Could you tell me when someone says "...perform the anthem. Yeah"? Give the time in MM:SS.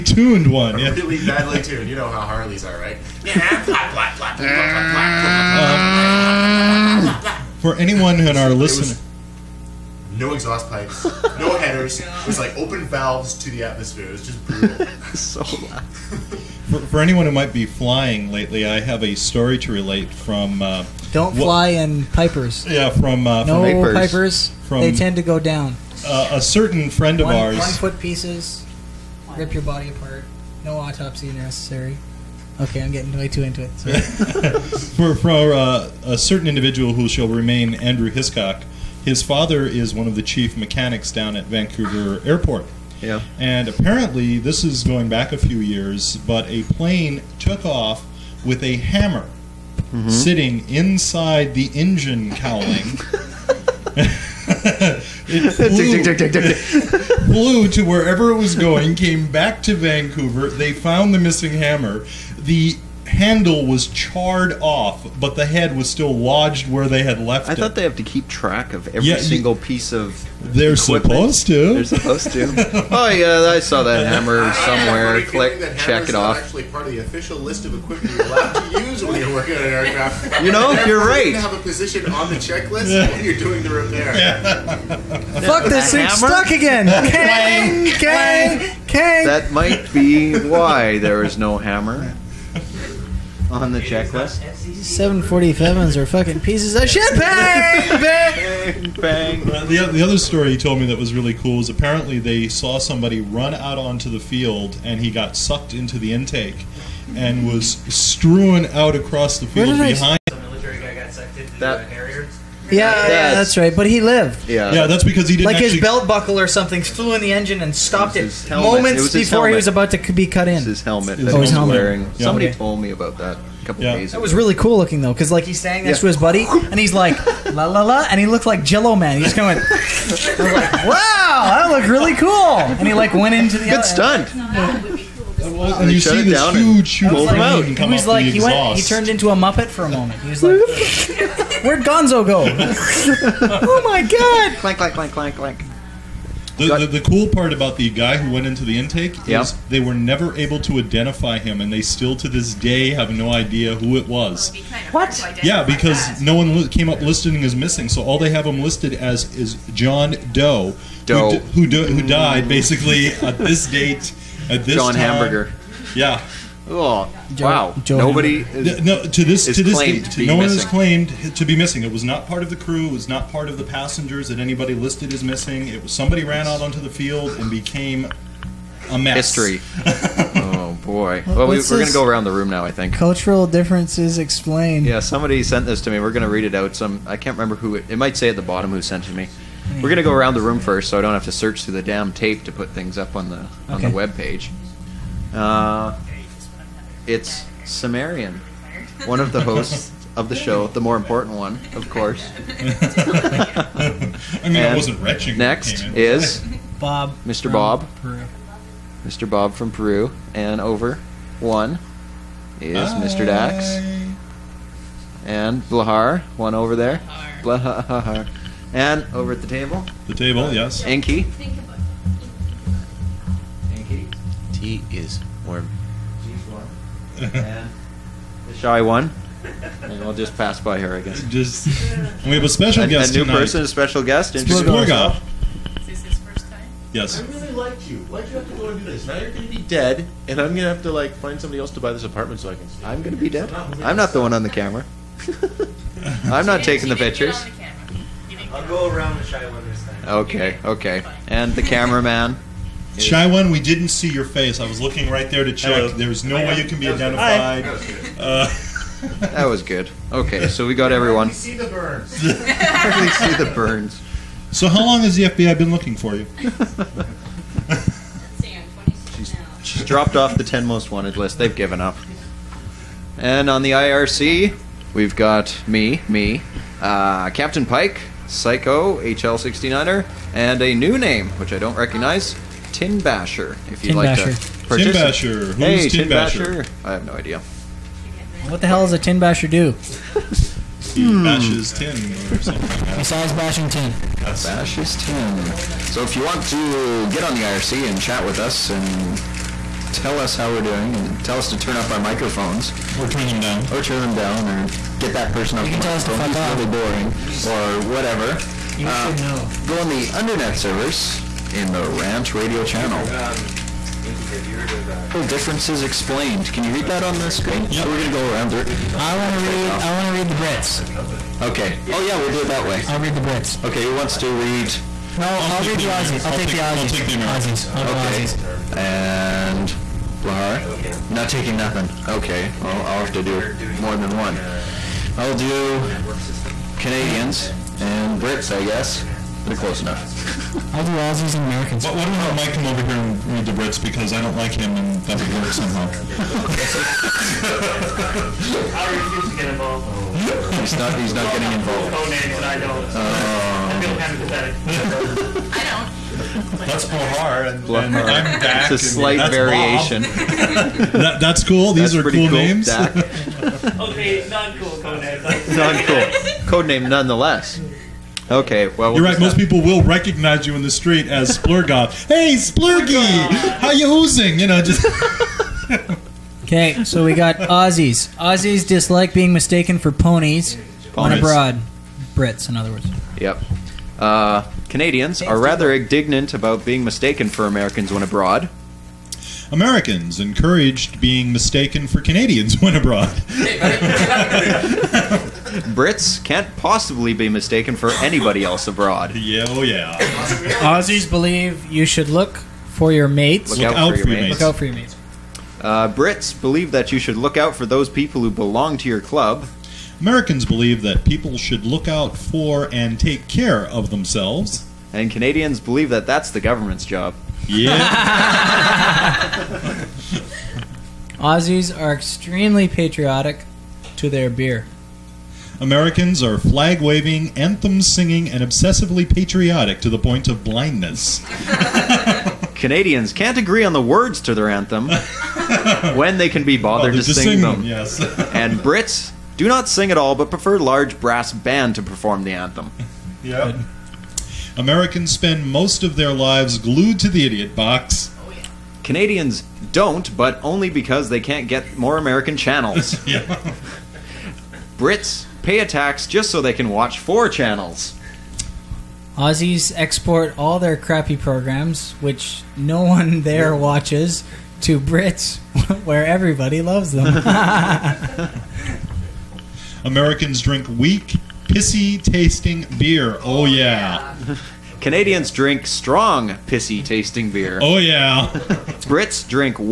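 07:21.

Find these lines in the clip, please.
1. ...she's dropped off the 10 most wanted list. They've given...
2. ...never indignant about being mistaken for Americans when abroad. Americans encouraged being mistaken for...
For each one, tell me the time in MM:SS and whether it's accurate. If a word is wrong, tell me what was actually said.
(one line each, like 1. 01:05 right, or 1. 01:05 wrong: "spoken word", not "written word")
1. 04:29 right
2. 06:25 wrong: "rather", not "never".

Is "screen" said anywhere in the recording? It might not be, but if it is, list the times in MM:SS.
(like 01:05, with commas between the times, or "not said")
05:17.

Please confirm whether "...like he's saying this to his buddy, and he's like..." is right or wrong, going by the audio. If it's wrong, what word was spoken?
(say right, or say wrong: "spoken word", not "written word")
right.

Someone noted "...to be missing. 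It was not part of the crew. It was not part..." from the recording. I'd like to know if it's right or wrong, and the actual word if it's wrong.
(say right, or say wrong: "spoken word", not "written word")
right.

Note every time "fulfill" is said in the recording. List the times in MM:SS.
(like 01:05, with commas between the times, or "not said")
not said.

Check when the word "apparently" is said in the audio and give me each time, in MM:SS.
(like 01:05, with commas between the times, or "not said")
00:43, 01:41.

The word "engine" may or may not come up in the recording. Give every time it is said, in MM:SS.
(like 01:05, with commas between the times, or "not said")
00:51, 01:57.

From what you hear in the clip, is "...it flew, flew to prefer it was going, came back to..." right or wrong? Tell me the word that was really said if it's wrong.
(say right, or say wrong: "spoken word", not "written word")
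wrong: "wherever", not "prefer".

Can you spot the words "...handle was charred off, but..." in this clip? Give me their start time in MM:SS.
01:03.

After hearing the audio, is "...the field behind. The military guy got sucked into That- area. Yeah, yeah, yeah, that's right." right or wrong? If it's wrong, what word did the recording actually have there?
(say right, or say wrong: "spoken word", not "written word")
right.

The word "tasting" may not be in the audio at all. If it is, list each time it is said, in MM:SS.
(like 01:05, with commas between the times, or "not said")
07:52, 07:56.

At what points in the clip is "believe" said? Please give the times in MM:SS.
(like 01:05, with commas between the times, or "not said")
06:41, 06:46, 06:50, 06:55.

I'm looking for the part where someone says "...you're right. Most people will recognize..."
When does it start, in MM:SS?
06:08.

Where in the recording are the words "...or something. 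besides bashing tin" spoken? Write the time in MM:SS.
04:52.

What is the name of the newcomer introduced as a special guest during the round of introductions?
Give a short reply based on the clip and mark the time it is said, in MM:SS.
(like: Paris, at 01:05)
Splurgov, at 03:54.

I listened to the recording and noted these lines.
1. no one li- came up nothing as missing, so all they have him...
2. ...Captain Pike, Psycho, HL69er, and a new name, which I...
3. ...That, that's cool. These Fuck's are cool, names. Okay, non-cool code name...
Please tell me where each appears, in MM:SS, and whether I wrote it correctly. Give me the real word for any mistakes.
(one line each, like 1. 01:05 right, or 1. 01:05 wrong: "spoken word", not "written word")
1. 02:36 wrong: "listing", not "nothing"
2. 04:37 right
3. 06:00 wrong: "That", not "Fuck".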